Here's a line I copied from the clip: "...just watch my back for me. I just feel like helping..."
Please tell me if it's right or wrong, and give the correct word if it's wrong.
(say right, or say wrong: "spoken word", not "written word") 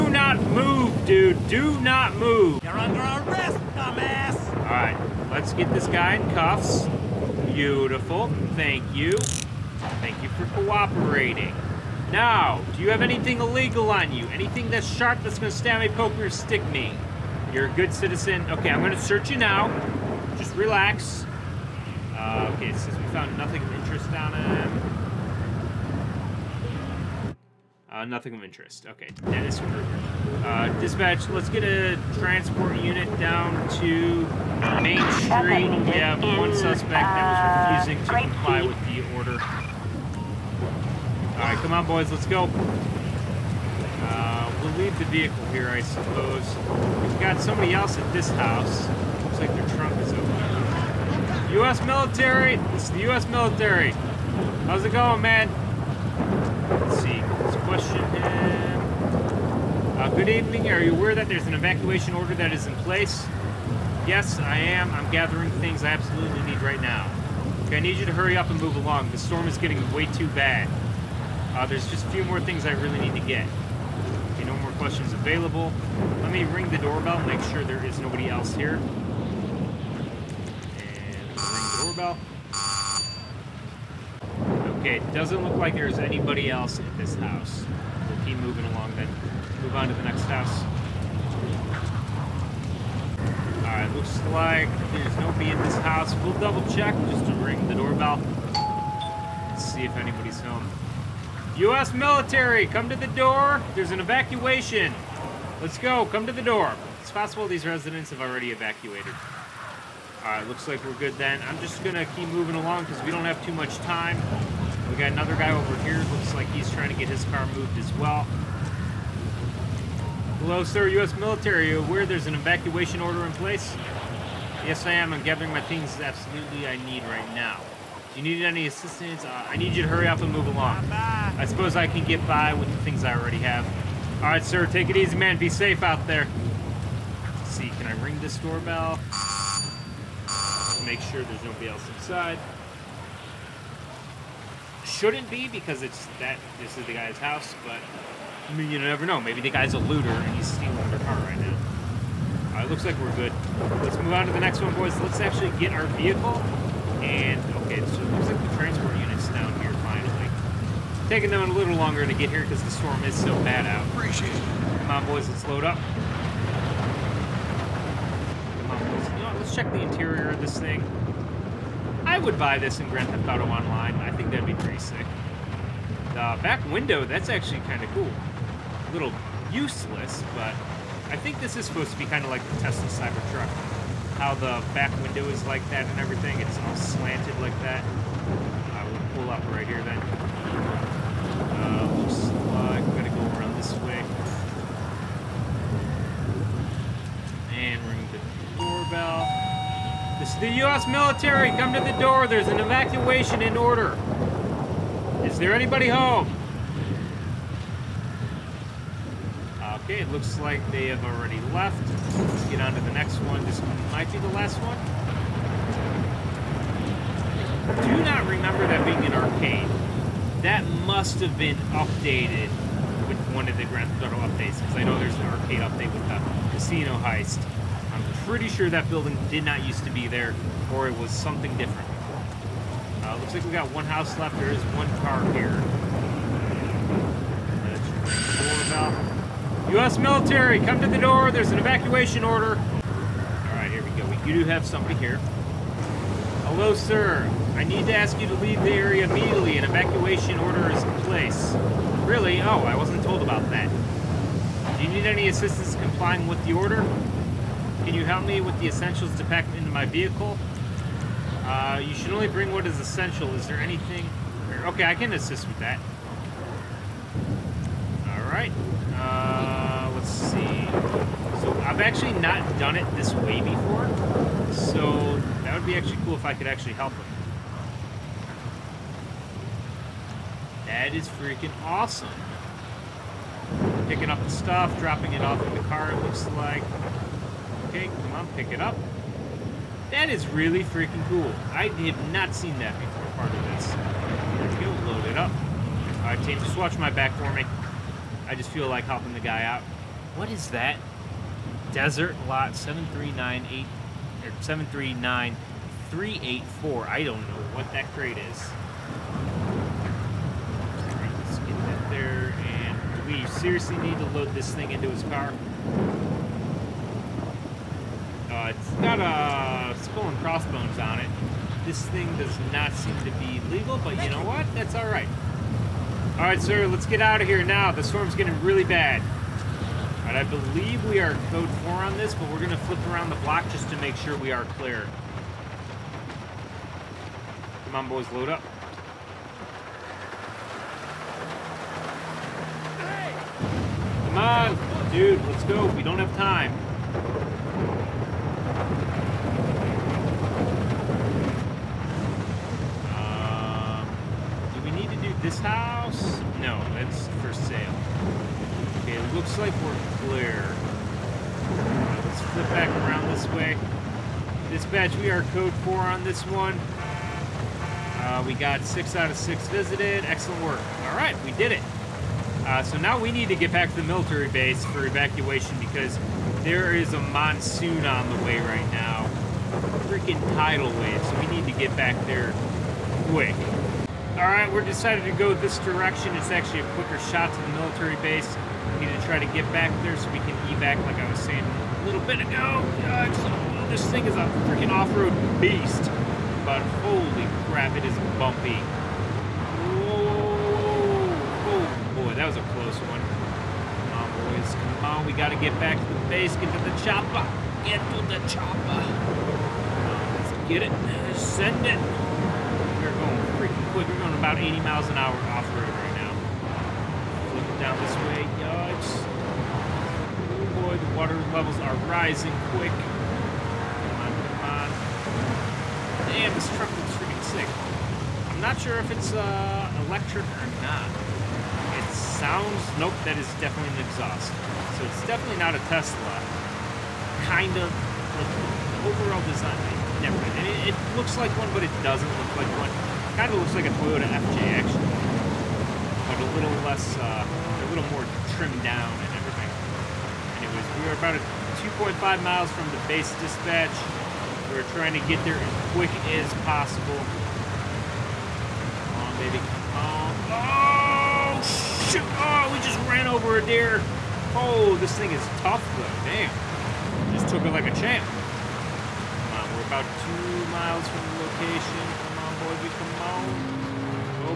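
right.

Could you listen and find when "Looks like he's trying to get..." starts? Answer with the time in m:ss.
1:56.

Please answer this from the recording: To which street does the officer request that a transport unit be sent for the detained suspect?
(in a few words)
Main Street.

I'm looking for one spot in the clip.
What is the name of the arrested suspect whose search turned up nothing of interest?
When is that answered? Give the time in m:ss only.
0:29.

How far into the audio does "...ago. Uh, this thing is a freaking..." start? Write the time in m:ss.
6:32.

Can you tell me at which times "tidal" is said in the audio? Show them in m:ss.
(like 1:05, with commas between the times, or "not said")
6:20.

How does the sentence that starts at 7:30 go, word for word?
Anyways, we were about 2.5 miles from the base dispatch.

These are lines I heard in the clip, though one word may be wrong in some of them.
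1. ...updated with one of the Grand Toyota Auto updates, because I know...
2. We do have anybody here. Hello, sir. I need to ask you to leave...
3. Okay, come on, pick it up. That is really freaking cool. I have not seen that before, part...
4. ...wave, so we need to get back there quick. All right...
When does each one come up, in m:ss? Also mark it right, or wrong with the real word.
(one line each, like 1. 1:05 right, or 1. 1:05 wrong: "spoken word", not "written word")
1. 3:41 wrong: "Theft", not "Toyota"
2. 4:04 wrong: "somebody", not "anybody"
3. 4:47 right
4. 6:20 right.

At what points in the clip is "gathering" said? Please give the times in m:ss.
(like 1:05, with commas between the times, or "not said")
1:05, 2:05.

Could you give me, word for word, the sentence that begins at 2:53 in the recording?
I think that'd be pretty sick.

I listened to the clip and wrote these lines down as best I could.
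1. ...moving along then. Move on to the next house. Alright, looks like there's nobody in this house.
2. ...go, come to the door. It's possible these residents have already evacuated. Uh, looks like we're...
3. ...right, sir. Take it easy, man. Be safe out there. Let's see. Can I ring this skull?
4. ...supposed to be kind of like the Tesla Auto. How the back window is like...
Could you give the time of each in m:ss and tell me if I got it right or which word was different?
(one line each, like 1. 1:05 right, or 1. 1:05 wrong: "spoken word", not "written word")
1. 1:28 right
2. 1:45 right
3. 2:14 wrong: "doorbell", not "skull"
4. 3:01 wrong: "Cybertruck", not "Auto".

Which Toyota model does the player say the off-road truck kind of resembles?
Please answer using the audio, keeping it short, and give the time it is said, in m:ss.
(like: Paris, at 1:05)
Toyota FJ, at 7:23.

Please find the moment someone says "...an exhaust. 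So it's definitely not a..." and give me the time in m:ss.
7:13.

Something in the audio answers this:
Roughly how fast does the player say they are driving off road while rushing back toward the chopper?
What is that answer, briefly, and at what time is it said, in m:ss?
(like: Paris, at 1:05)
80 miles an hour, at 6:54.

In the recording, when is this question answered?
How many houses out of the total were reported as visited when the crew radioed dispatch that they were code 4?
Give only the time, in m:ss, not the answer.
6:08.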